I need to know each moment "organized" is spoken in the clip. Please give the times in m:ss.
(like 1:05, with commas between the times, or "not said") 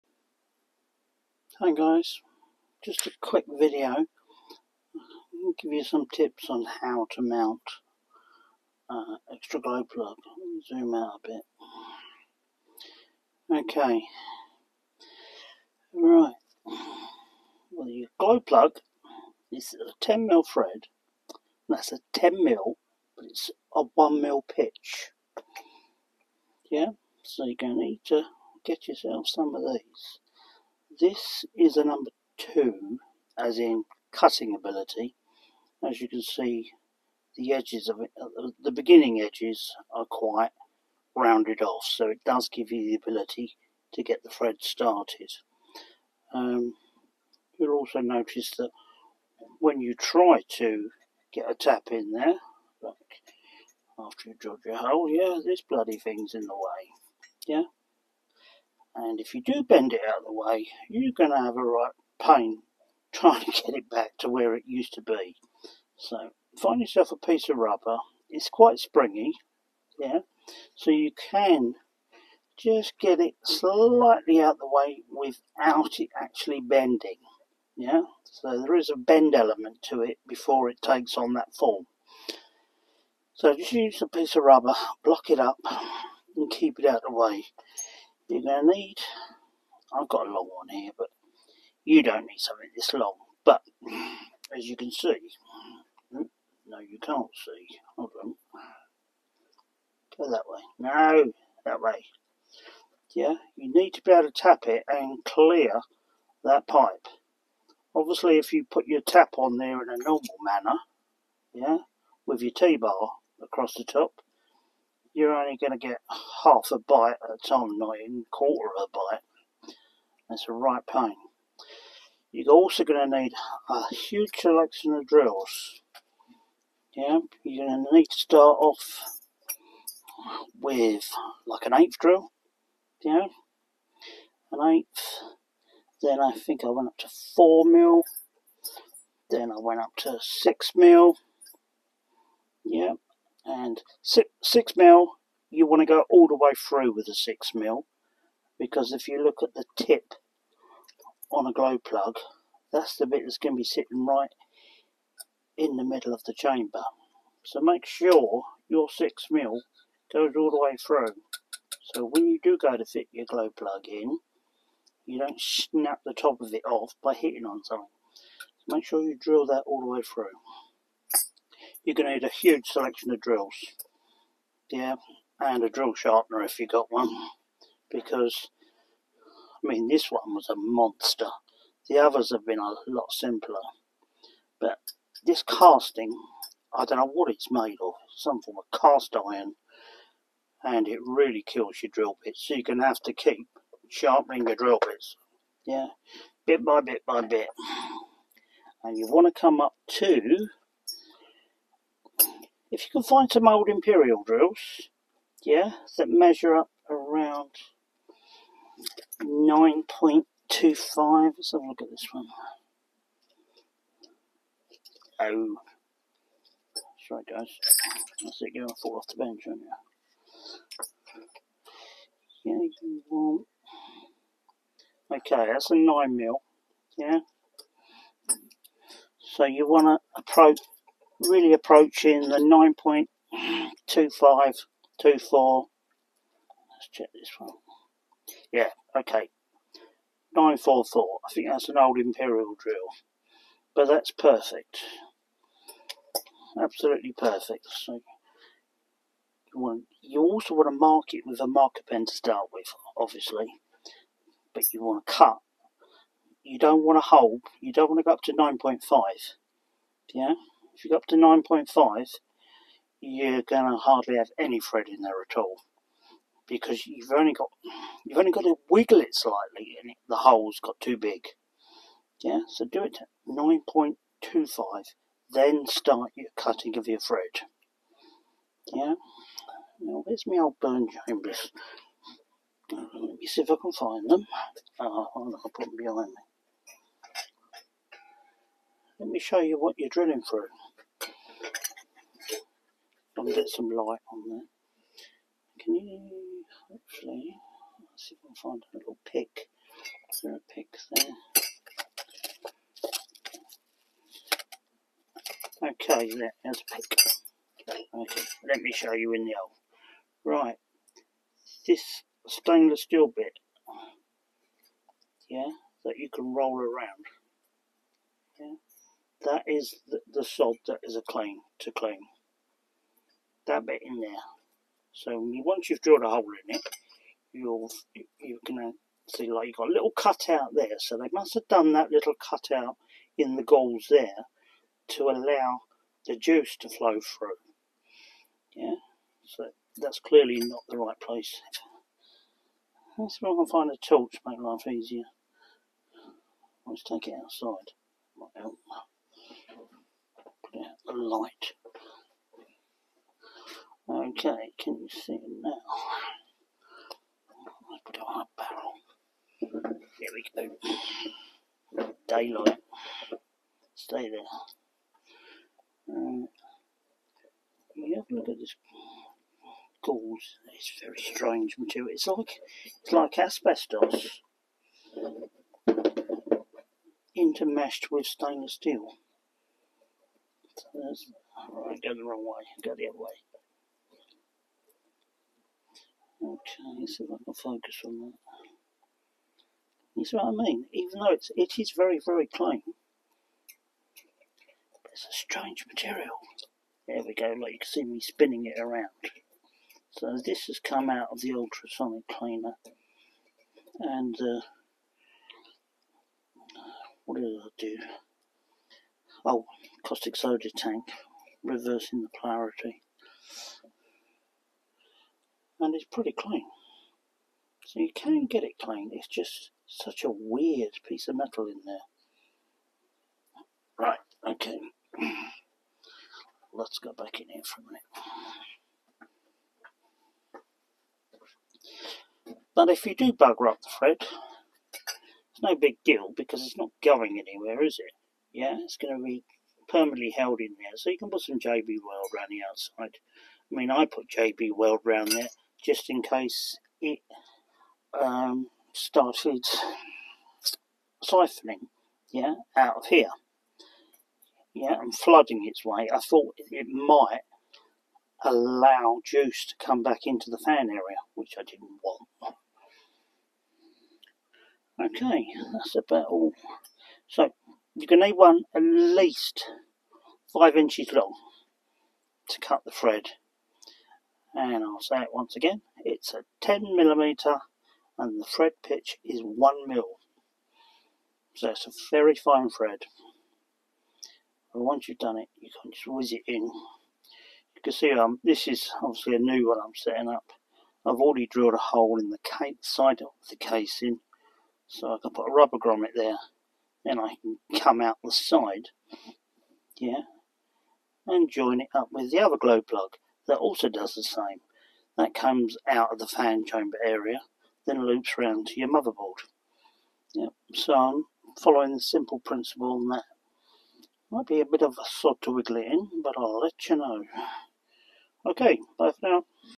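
not said.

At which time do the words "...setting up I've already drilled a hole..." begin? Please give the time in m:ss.
8:09.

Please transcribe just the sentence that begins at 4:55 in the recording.
Can you hopefully see if I can find a little pick?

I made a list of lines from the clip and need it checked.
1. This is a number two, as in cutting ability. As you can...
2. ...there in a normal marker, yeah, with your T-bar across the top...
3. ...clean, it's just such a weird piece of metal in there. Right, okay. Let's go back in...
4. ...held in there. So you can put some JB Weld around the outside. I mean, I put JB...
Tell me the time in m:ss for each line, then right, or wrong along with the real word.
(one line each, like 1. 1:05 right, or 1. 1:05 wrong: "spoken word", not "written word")
1. 0:30 right
2. 1:49 wrong: "manner", not "marker"
3. 6:58 right
4. 7:20 right.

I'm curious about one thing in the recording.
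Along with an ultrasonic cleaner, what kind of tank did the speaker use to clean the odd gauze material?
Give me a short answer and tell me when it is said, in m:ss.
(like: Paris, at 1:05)
caustic soda tank, at 6:49.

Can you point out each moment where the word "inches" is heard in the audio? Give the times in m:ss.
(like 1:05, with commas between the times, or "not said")
7:50.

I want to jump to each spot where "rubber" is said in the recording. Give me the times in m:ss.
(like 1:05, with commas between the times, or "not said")
1:07, 1:24, 8:15.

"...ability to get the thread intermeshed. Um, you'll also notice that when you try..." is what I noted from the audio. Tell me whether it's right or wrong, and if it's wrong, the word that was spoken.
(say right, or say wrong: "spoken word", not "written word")
wrong: "started", not "intermeshed".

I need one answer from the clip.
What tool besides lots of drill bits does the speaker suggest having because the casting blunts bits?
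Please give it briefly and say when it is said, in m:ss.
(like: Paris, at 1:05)
drill sharpener, at 2:55.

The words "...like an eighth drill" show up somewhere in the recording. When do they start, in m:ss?
2:11.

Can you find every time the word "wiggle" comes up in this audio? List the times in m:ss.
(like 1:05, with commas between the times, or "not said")
4:28, 8:35.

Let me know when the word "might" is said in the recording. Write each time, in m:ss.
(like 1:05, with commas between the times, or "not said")
5:48, 7:36, 8:34.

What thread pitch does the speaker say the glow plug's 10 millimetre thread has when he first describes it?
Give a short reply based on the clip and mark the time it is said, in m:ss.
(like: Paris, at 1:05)
1 mil, at 0:23.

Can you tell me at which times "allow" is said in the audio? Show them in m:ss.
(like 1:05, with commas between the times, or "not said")
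5:35, 7:38.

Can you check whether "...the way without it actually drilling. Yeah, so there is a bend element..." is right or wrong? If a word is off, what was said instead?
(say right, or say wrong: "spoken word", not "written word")
wrong: "bending", not "drilling".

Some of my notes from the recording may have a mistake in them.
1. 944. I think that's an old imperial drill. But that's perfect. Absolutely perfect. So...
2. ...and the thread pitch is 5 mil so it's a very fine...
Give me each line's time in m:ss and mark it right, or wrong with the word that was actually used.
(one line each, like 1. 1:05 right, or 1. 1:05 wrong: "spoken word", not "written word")
1. 4:00 right
2. 7:57 wrong: "1", not "5".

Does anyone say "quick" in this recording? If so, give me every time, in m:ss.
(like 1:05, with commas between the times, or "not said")
0:03.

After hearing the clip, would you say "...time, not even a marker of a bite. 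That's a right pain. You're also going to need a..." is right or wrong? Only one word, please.
wrong.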